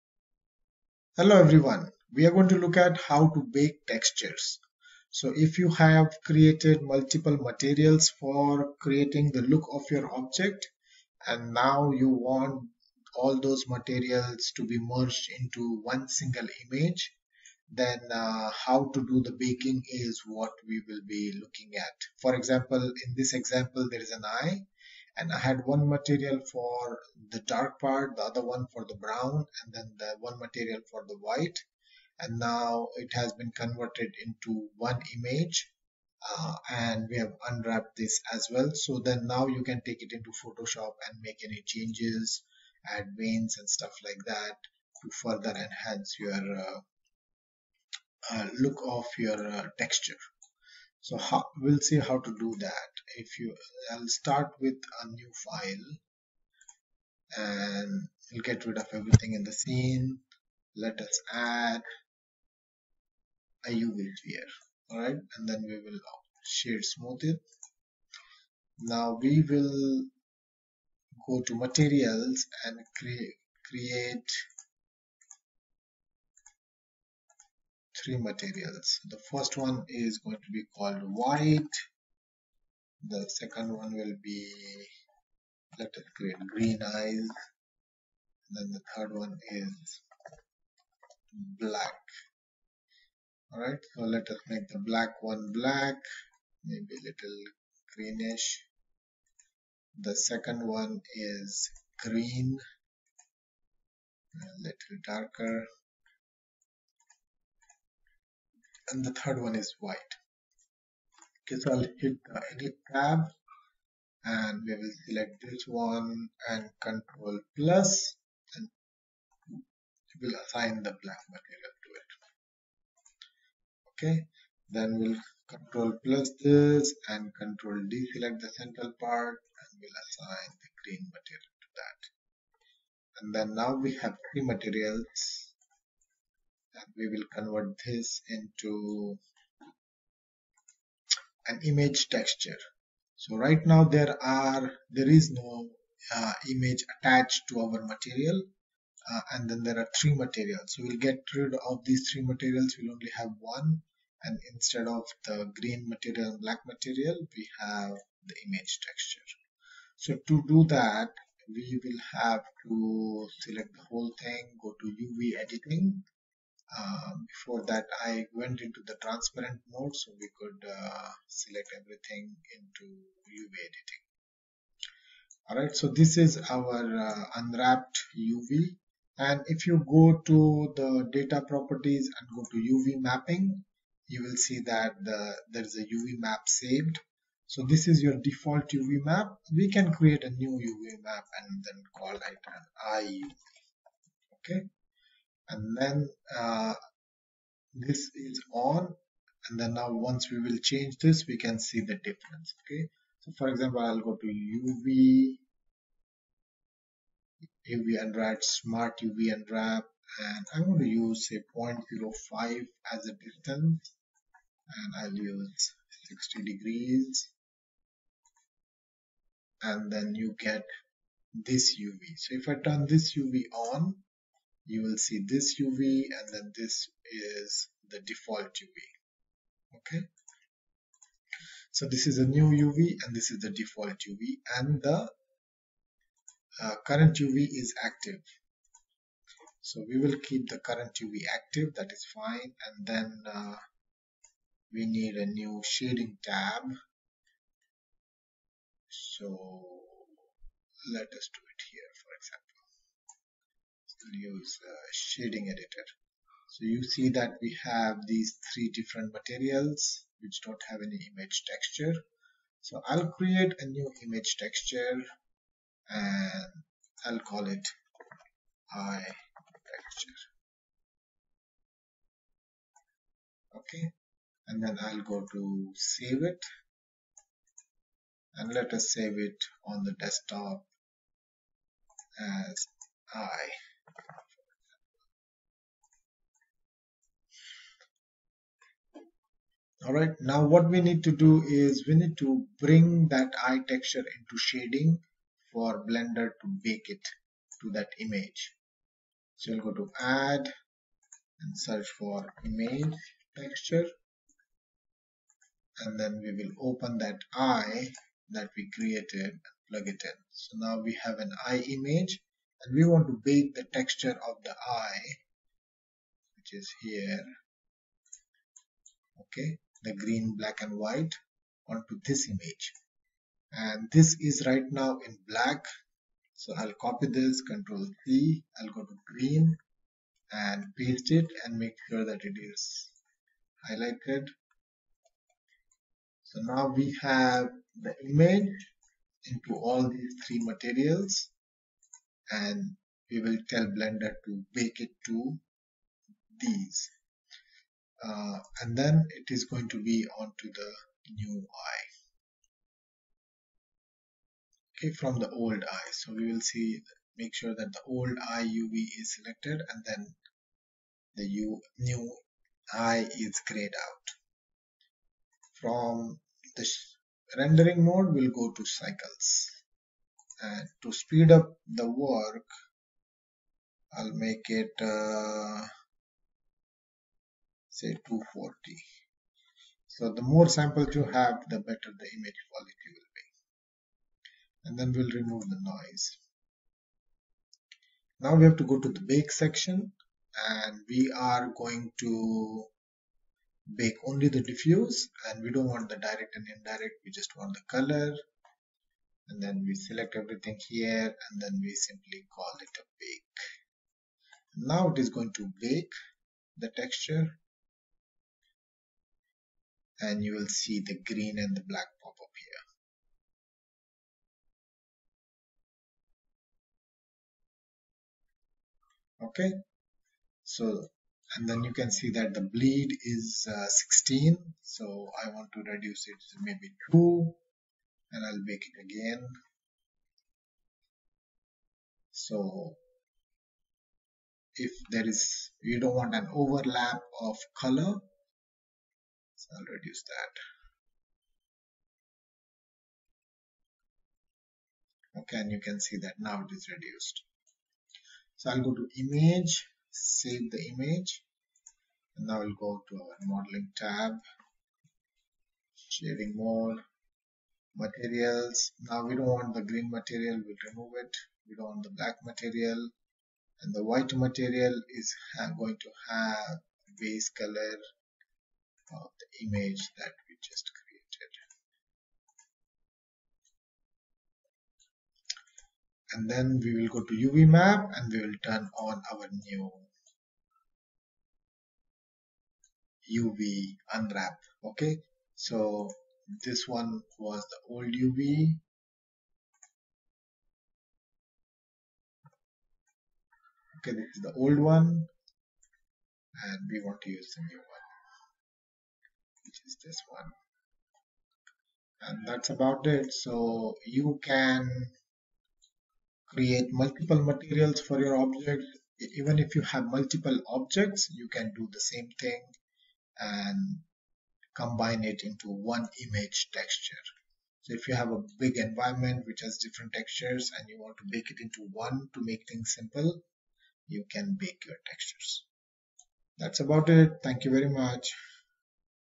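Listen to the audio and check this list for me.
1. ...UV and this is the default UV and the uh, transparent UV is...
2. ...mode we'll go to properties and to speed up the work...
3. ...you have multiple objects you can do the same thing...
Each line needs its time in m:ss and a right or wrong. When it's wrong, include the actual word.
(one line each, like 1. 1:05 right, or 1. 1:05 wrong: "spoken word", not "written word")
1. 3:52 wrong: "current", not "transparent"
2. 6:07 wrong: "cycles", not "properties"
3. 8:29 right.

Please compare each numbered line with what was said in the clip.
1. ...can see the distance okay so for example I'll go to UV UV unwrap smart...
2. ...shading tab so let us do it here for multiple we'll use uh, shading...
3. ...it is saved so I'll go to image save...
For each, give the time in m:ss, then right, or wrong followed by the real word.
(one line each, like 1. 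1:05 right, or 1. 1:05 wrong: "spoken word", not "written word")
1. 3:21 wrong: "difference", not "distance"
2. 4:05 wrong: "example", not "multiple"
3. 7:26 wrong: "reduced", not "saved".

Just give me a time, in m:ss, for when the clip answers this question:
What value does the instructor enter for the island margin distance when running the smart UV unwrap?
3:31.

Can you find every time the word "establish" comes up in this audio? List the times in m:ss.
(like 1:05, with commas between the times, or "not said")
not said.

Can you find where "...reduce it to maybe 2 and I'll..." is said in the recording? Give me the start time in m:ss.
7:05.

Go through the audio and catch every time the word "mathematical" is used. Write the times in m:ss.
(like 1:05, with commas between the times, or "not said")
not said.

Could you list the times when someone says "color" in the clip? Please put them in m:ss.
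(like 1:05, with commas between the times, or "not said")
6:37, 7:17, 7:47.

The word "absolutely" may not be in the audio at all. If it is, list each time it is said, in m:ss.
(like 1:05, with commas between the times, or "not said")
not said.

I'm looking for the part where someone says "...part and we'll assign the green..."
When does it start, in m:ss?
2:09.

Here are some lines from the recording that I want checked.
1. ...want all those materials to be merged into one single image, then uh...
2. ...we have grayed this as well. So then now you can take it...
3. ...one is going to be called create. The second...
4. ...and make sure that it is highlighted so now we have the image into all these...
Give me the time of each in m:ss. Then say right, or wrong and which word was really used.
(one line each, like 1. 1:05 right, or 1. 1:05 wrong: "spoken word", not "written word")
1. 0:12 right
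2. 0:37 wrong: "unwrapped", not "grayed"
3. 1:19 wrong: "white", not "create"
4. 5:31 right.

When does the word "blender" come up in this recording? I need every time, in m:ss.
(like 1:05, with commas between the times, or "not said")
4:55, 5:43.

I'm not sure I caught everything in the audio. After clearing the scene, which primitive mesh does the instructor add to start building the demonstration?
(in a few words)
UV sphere.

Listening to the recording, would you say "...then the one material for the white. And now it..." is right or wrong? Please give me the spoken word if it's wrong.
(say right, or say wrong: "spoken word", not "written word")
right.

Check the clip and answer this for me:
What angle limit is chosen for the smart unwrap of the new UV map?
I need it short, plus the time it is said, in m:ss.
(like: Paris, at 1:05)
60 degrees, at 3:36.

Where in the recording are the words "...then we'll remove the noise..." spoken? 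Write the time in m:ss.
6:24.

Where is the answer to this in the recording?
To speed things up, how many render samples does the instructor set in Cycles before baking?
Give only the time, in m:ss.
6:18.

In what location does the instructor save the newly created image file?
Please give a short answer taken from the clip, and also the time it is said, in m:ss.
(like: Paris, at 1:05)
The desktop, at 4:39.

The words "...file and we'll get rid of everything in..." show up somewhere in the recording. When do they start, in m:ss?
0:55.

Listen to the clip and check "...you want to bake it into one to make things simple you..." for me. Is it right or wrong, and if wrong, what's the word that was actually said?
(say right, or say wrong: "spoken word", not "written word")
right.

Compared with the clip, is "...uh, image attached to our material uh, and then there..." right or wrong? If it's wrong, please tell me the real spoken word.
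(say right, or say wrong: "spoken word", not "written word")
right.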